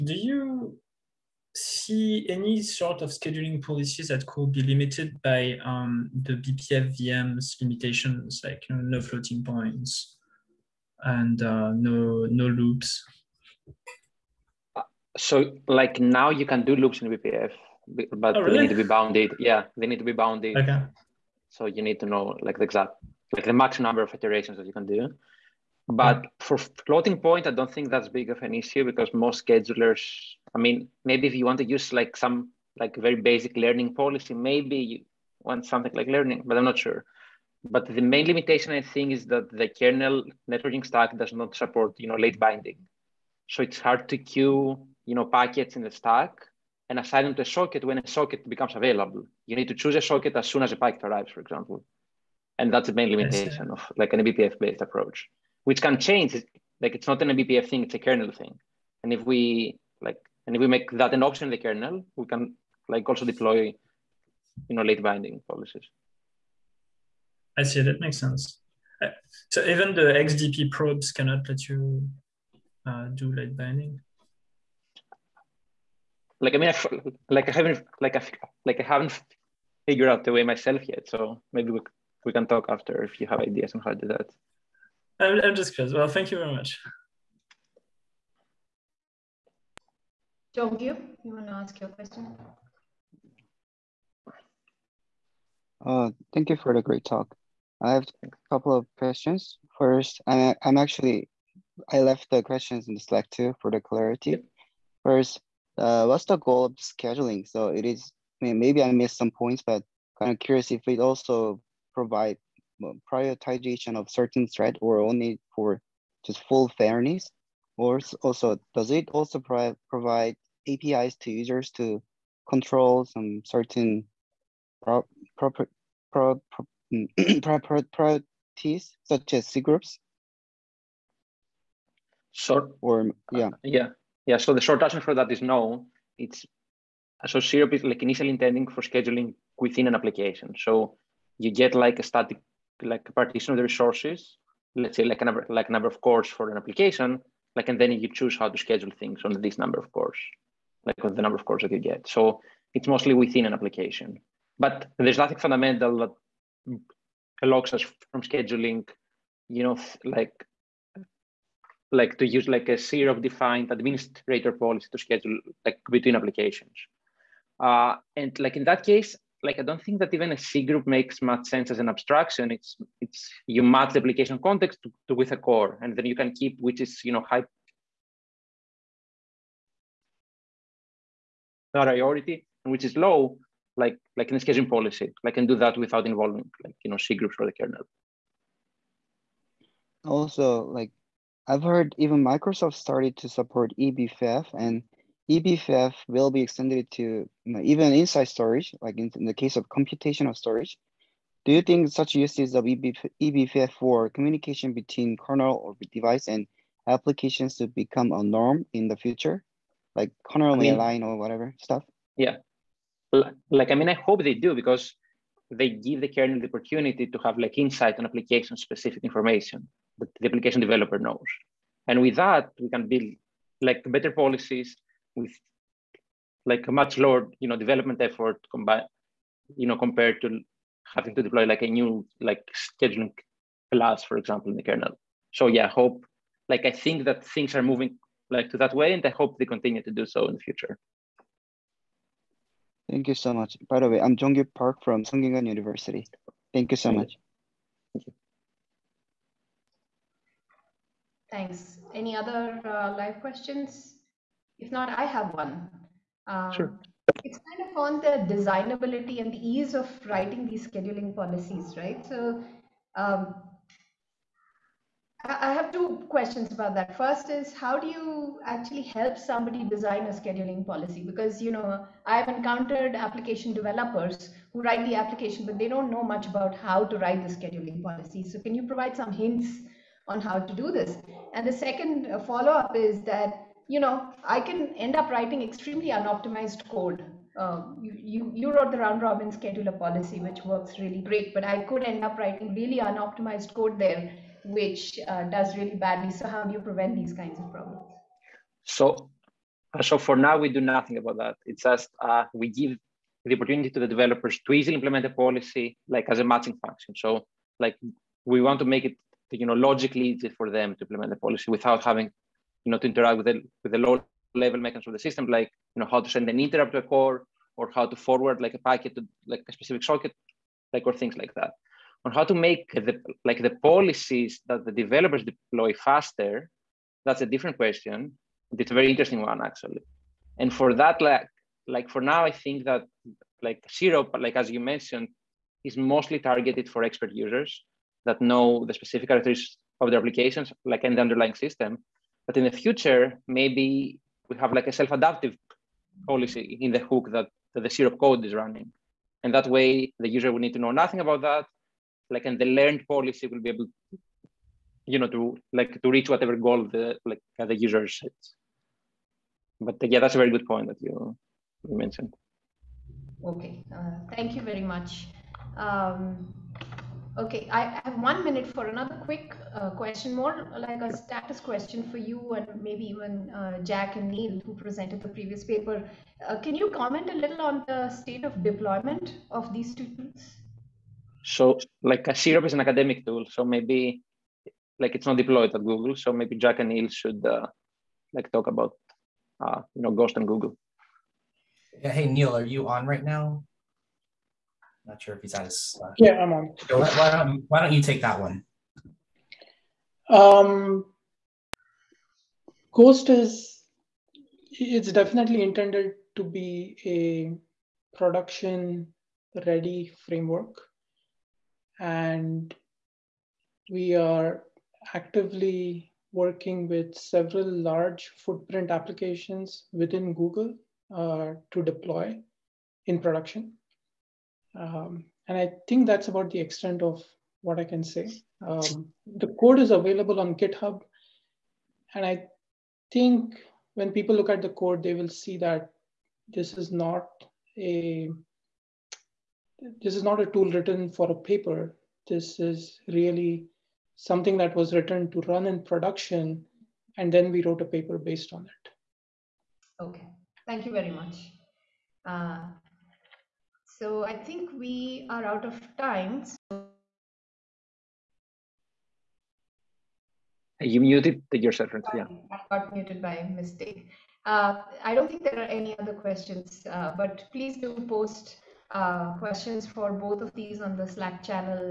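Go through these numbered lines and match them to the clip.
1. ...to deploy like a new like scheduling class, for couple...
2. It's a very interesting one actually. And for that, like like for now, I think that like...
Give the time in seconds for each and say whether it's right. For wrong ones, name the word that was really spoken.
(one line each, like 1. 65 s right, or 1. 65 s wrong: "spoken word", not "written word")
1. 231 s wrong: "example", not "couple"
2. 328 s right.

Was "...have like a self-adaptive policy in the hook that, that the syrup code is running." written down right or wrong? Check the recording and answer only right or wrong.
right.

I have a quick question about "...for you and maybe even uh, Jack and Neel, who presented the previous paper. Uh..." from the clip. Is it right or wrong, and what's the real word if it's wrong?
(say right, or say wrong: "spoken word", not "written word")
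right.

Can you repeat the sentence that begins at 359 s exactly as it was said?
But yeah, that's a very good point that you, you mentioned.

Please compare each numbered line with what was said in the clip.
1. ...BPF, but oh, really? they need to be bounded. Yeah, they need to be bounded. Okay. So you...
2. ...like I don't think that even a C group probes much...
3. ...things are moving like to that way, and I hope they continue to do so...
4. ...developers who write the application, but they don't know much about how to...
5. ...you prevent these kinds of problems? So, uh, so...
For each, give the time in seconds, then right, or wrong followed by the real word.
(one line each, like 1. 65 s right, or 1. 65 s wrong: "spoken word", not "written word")
1. 17 s right
2. 169 s wrong: "makes", not "probes"
3. 237 s right
4. 273 s right
5. 296 s right.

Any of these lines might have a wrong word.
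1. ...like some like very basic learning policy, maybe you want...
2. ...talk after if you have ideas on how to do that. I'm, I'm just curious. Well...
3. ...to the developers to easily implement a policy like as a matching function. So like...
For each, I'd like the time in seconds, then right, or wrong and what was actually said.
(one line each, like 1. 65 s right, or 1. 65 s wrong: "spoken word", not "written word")
1. 31 s right
2. 82 s right
3. 303 s right.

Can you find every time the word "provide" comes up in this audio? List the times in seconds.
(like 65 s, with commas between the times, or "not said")
111 s, 119 s, 278 s.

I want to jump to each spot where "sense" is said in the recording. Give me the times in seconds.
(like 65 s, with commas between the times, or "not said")
68 s, 171 s.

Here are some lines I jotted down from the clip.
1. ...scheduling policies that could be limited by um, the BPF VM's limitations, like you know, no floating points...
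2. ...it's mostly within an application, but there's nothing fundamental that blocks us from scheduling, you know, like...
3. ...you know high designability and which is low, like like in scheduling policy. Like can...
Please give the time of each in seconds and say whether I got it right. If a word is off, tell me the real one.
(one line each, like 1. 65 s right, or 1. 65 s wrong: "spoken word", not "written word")
1. 3 s right
2. 152 s right
3. 177 s wrong: "priority", not "designability".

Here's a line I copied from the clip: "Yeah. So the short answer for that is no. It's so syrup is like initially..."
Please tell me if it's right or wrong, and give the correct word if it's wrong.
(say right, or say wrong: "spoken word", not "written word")
right.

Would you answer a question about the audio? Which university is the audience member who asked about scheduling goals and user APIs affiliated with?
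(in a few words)
Sungkyunkwan University.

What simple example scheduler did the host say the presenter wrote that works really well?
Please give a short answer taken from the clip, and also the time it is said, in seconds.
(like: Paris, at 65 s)
round robin, at 288 s.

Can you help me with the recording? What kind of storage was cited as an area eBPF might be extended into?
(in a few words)
computational storage.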